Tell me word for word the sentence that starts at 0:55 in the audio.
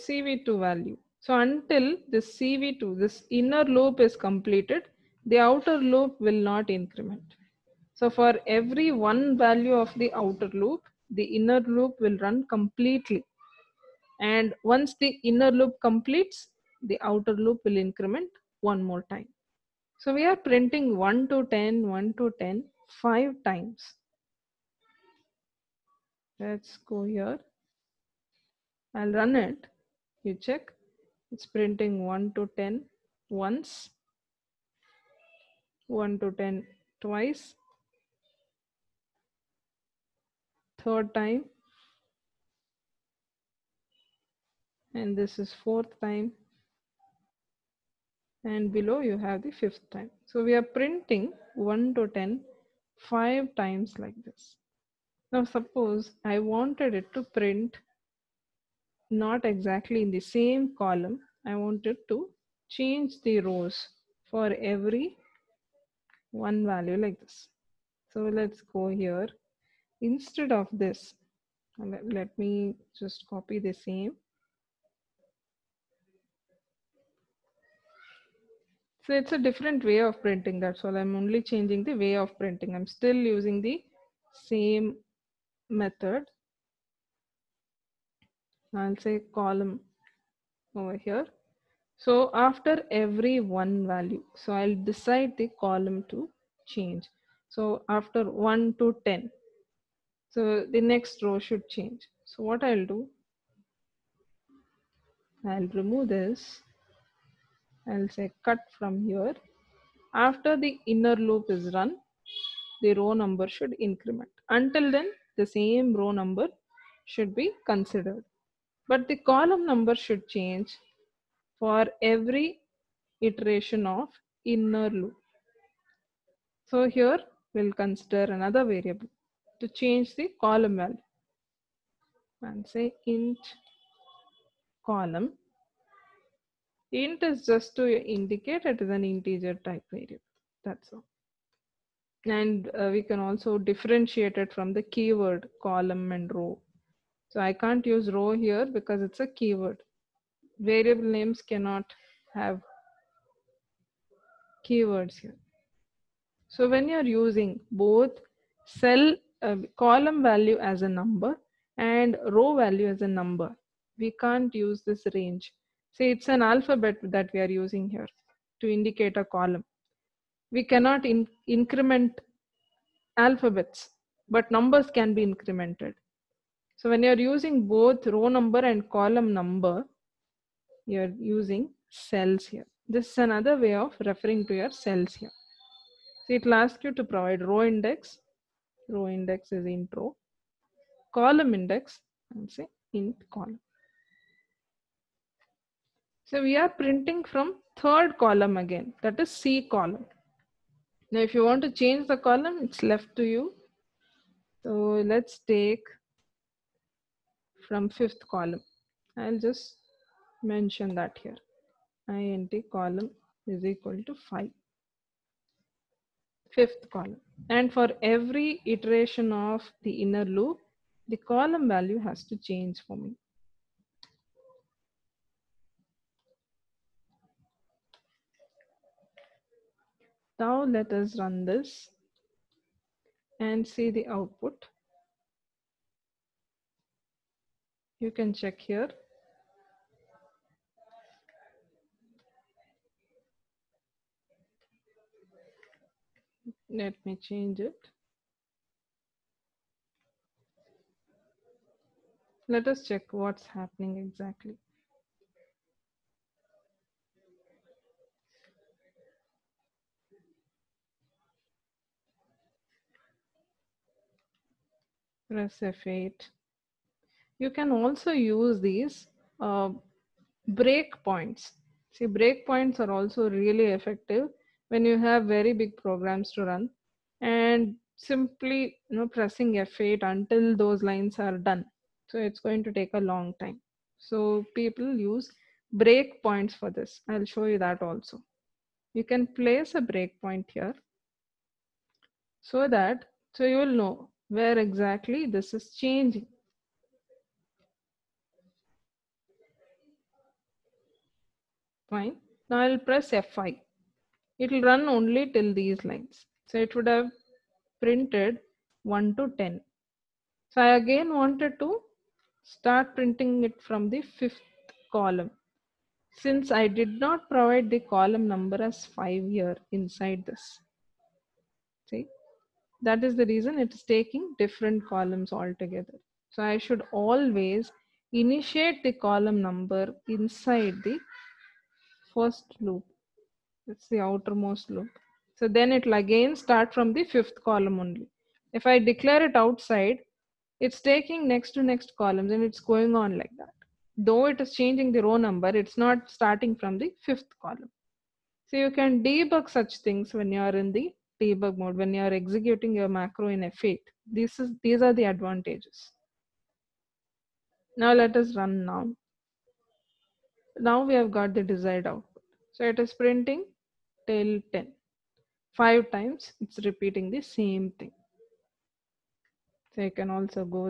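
Now suppose I wanted it to print not exactly in the same column.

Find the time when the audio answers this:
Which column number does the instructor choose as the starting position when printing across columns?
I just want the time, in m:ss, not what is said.
3:32.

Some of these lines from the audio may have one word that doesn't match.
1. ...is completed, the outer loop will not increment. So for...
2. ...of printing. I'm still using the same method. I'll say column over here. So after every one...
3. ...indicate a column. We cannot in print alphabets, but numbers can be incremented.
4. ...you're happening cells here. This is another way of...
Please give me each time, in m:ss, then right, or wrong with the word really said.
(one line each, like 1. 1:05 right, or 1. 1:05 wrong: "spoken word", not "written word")
1. 0:03 right
2. 1:22 right
3. 2:48 wrong: "increment", not "print"
4. 3:00 wrong: "using", not "happening".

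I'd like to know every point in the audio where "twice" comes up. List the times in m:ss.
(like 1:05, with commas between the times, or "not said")
0:37.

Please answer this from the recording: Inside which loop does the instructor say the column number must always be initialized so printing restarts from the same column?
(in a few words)
The outermost loop.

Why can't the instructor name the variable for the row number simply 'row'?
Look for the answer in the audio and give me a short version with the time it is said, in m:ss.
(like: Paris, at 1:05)
It's a keyword, at 2:29.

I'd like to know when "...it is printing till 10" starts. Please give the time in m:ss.
6:02.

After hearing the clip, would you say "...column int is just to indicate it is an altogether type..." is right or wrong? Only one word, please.
wrong.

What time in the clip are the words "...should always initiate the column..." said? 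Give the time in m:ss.
5:26.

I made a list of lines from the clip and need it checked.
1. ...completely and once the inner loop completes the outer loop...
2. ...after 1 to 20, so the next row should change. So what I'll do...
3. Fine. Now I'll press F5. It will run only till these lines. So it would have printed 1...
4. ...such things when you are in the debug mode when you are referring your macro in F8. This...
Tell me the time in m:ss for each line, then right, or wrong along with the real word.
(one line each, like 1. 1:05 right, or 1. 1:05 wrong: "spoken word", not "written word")
1. 0:12 right
2. 1:37 wrong: "10", not "20"
3. 5:01 right
4. 5:49 wrong: "executing", not "referring".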